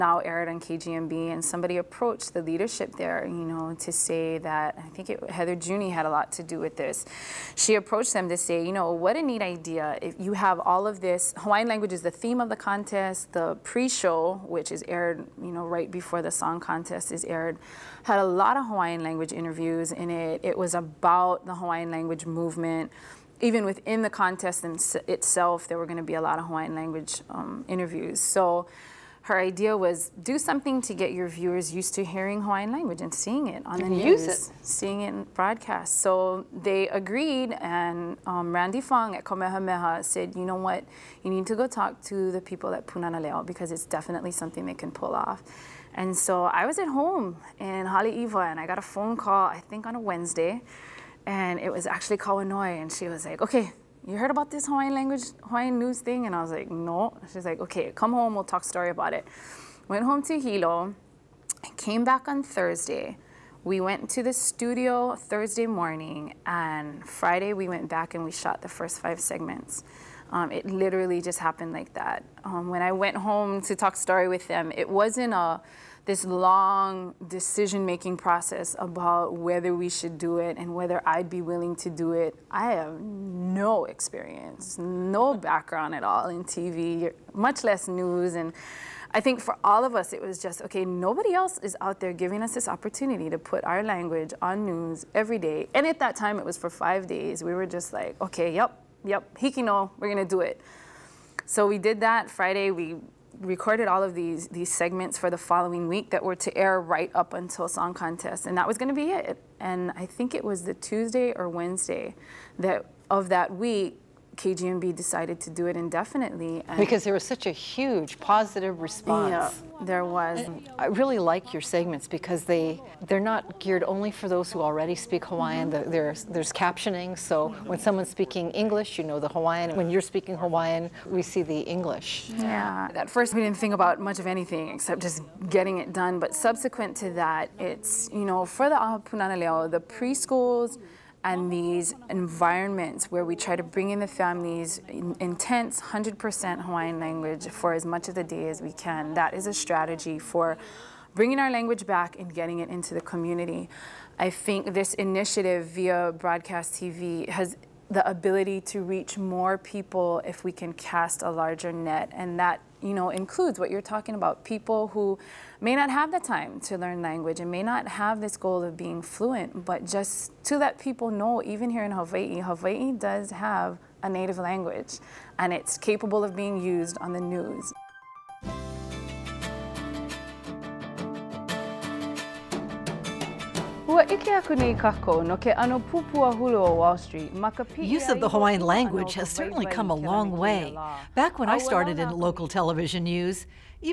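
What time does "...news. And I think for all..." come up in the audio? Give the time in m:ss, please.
1:27.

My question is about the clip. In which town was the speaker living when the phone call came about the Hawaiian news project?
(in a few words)
Haleiwa.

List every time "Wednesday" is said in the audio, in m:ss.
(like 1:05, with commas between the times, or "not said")
0:49, 1:51.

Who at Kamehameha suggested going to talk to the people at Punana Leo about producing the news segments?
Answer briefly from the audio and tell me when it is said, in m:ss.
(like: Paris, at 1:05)
Randie Fong, at 0:38.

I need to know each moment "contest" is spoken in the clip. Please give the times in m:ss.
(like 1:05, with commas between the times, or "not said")
0:12, 0:16, 0:24, 1:47.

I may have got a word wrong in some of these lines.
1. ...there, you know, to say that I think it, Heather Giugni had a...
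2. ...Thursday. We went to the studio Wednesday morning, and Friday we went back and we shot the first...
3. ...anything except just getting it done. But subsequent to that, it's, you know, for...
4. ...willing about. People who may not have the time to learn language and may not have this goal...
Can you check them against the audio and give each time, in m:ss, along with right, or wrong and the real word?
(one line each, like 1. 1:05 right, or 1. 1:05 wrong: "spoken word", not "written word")
1. 0:02 right
2. 1:02 wrong: "Thursday", not "Wednesday"
3. 2:14 right
4. 2:43 wrong: "talking", not "willing".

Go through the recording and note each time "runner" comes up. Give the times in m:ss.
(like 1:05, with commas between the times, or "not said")
not said.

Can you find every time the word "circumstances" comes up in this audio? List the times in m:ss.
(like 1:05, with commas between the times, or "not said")
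not said.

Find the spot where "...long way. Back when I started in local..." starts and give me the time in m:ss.
3:09.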